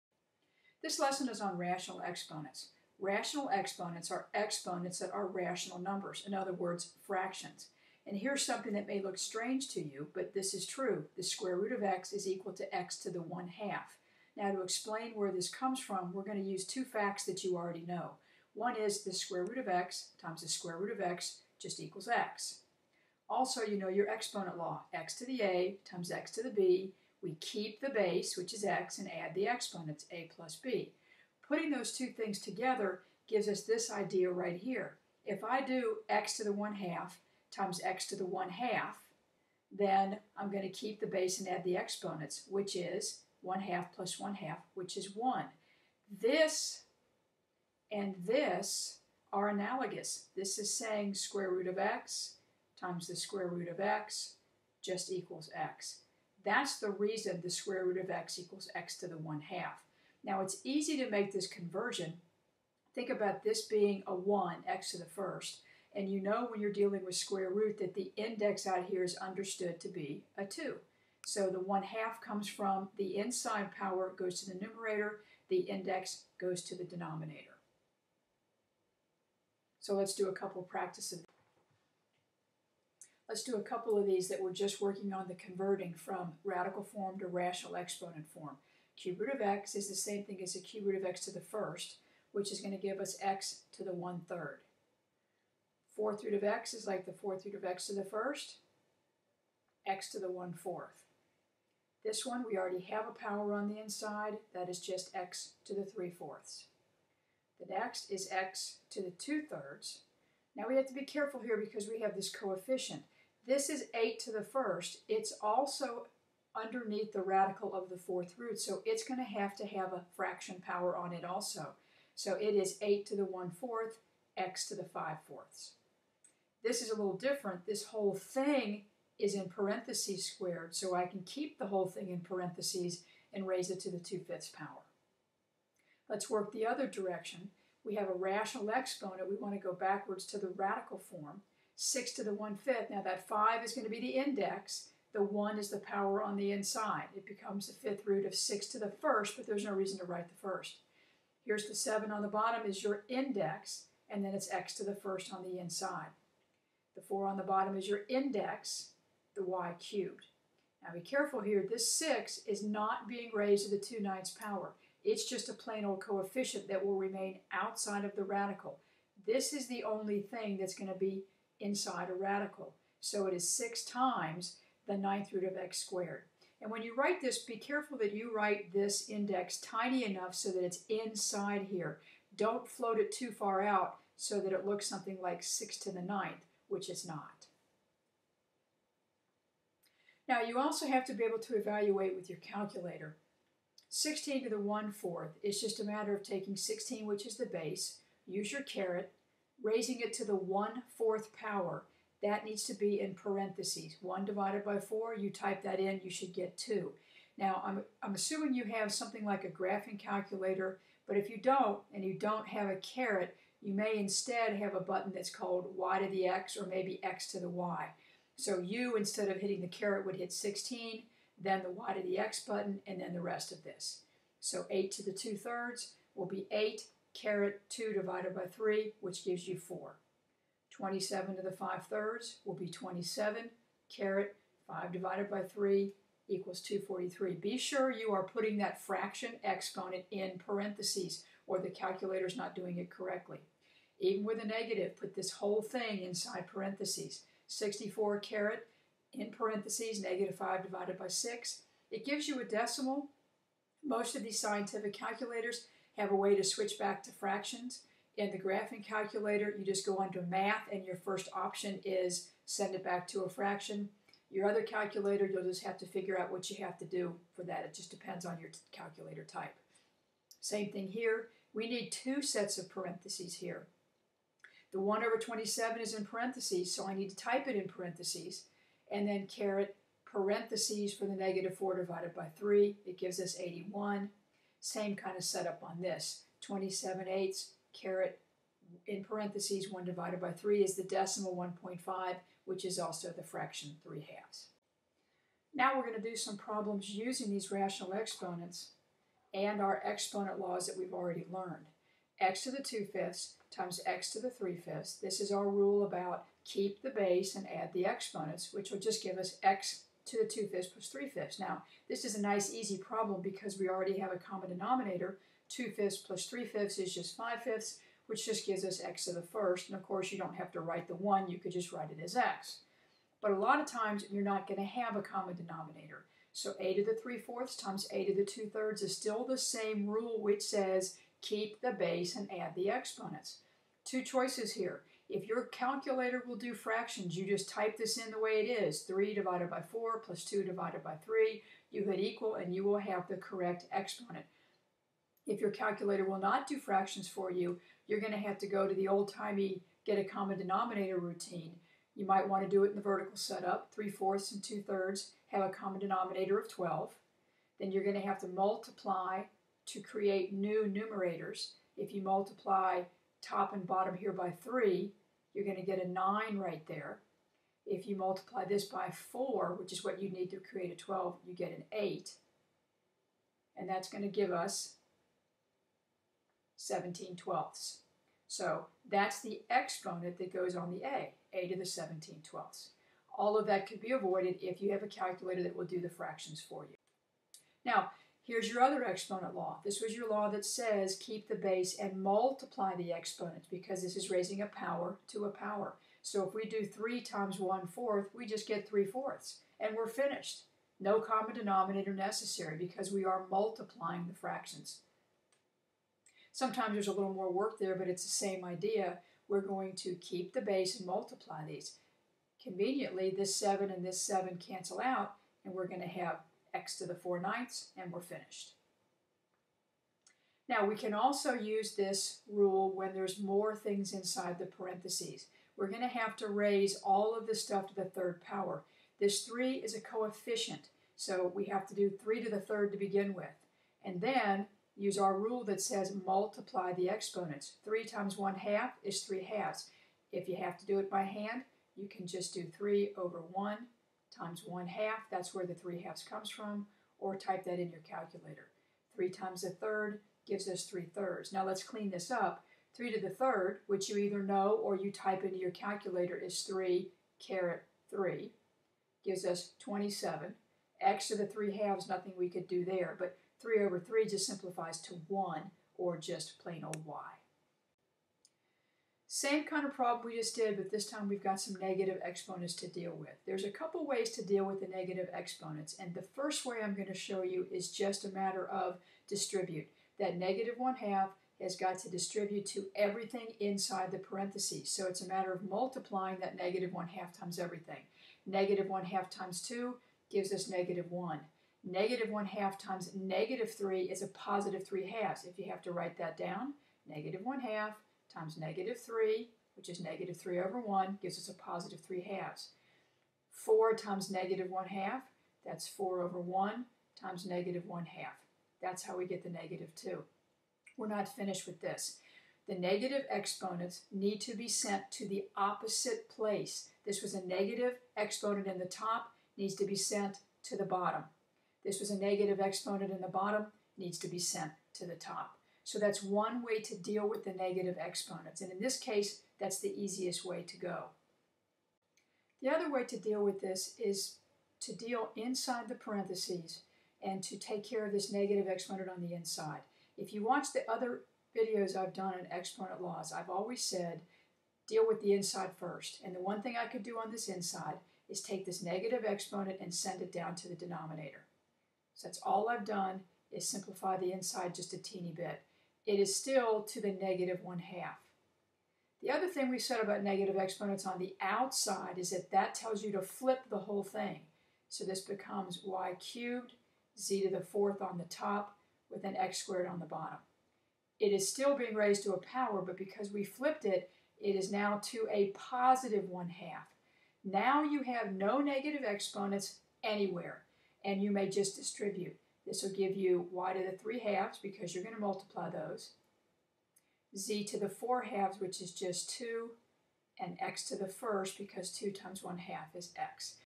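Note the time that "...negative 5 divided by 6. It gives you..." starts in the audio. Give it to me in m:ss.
4:10.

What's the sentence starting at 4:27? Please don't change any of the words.
It just depends on your calculator type.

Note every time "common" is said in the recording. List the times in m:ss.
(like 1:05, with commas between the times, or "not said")
5:14, 5:25, 5:50, 5:55, 6:41.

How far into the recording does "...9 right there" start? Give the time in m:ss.
6:05.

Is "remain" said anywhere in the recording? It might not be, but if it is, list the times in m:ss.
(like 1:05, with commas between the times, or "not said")
2:46.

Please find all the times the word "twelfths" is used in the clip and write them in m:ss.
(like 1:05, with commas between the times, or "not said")
6:17, 6:22.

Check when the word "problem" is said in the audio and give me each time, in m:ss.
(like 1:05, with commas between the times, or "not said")
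4:56, 5:12, 7:49.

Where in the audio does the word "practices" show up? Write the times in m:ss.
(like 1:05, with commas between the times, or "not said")
1:20.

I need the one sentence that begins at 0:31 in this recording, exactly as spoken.
Putting those two things together gives us this idea right here.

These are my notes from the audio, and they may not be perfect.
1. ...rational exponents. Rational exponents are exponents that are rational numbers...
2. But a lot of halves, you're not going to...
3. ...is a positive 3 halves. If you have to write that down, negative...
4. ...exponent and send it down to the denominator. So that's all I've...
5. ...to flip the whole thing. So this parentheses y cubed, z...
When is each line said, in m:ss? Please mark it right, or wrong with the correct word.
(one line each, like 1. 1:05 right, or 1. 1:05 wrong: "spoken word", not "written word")
1. 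0:01 right
2. 5:23 wrong: "times", not "halves"
3. 8:13 right
4. 9:09 right
5. 9:22 wrong: "becomes", not "parentheses".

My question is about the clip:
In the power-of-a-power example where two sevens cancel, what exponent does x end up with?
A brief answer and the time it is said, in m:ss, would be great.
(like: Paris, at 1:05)
4/9, at 6:56.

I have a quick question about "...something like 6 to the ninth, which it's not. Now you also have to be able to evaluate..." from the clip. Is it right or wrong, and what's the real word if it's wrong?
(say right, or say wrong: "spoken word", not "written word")
right.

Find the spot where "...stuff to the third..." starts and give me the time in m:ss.
7:07.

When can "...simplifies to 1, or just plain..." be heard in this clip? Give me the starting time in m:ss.
7:44.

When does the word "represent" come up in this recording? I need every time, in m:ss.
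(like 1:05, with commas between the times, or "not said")
not said.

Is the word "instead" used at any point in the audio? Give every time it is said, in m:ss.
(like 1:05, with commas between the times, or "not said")
3:33, 3:38.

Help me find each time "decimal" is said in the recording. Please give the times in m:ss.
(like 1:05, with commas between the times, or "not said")
4:12, 4:50.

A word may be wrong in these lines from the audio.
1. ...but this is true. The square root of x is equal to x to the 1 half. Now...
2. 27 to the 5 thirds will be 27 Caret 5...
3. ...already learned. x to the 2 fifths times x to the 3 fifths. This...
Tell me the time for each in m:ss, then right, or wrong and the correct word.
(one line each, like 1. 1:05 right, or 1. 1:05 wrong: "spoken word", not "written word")
1. 0:10 right
2. 3:50 right
3. 5:00 right.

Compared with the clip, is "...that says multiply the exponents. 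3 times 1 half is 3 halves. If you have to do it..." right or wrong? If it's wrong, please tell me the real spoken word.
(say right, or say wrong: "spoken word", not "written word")
right.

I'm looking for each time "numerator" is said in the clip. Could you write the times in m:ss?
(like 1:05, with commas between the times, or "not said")
1:14, 6:00.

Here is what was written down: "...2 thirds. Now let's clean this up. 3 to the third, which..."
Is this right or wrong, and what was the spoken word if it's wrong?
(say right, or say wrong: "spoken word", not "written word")
wrong: "3", not "2".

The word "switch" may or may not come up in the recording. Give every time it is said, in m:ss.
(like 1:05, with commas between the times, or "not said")
4:16.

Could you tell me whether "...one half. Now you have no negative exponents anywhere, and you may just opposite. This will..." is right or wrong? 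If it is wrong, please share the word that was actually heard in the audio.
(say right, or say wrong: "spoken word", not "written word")
wrong: "distribute", not "opposite".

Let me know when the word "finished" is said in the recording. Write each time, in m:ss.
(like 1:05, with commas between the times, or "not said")
6:39, 6:58, 8:31.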